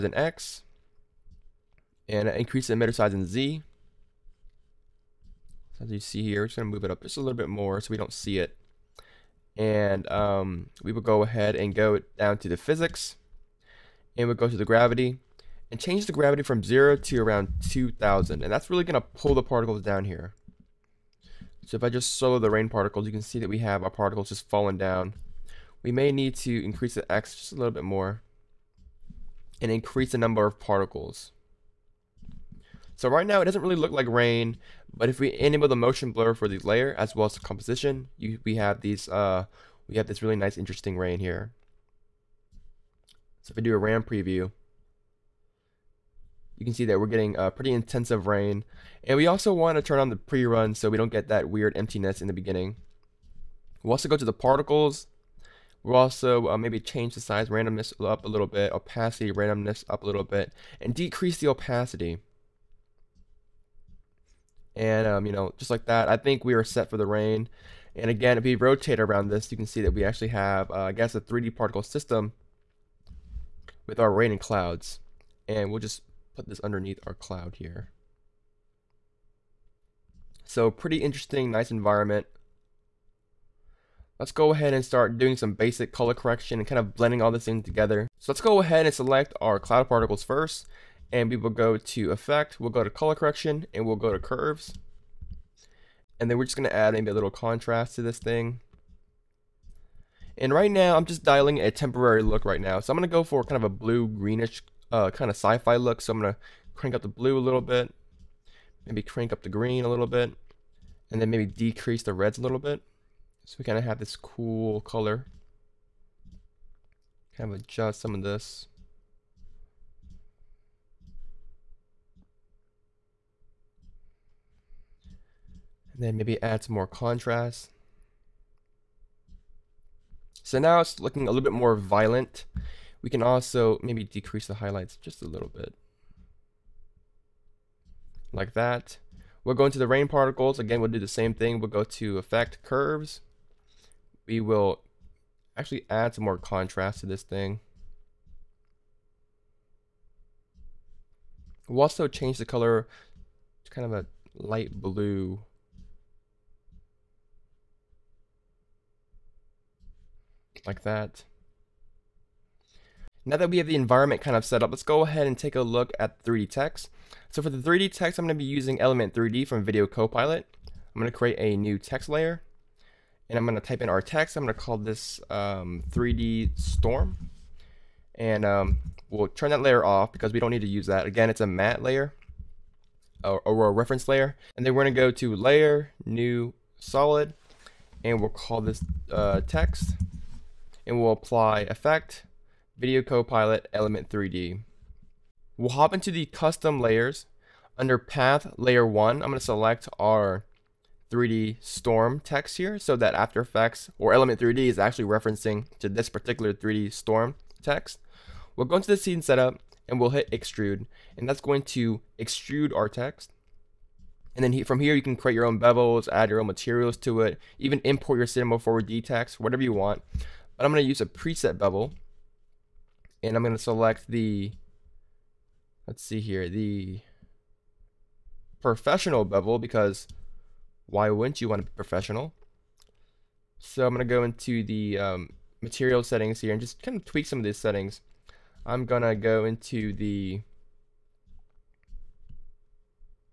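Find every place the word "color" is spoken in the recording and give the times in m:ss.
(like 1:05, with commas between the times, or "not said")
1:25, 1:32, 1:54, 2:32.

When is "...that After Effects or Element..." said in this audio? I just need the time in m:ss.
3:22.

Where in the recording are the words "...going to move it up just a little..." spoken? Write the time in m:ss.
0:06.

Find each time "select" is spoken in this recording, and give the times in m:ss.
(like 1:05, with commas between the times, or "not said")
1:28, 3:19, 3:43.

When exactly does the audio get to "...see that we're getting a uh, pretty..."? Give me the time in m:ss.
0:46.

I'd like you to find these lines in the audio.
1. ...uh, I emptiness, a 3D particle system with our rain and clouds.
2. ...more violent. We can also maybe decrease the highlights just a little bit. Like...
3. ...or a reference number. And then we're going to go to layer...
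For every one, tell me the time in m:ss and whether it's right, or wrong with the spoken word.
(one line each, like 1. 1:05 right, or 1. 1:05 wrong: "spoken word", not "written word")
1. 1:10 wrong: "guess", not "emptiness"
2. 2:11 right
3. 3:03 wrong: "layer", not "number".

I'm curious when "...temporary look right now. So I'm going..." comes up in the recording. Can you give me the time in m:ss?
1:41.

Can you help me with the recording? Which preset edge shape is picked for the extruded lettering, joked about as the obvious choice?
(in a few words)
professional bevel.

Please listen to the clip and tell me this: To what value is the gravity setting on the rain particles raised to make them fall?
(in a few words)
2000.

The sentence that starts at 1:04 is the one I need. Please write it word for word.
And, um, you know, just like that, I think we are set for the rain.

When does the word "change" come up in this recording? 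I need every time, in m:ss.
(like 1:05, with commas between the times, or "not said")
0:15, 0:56, 2:32.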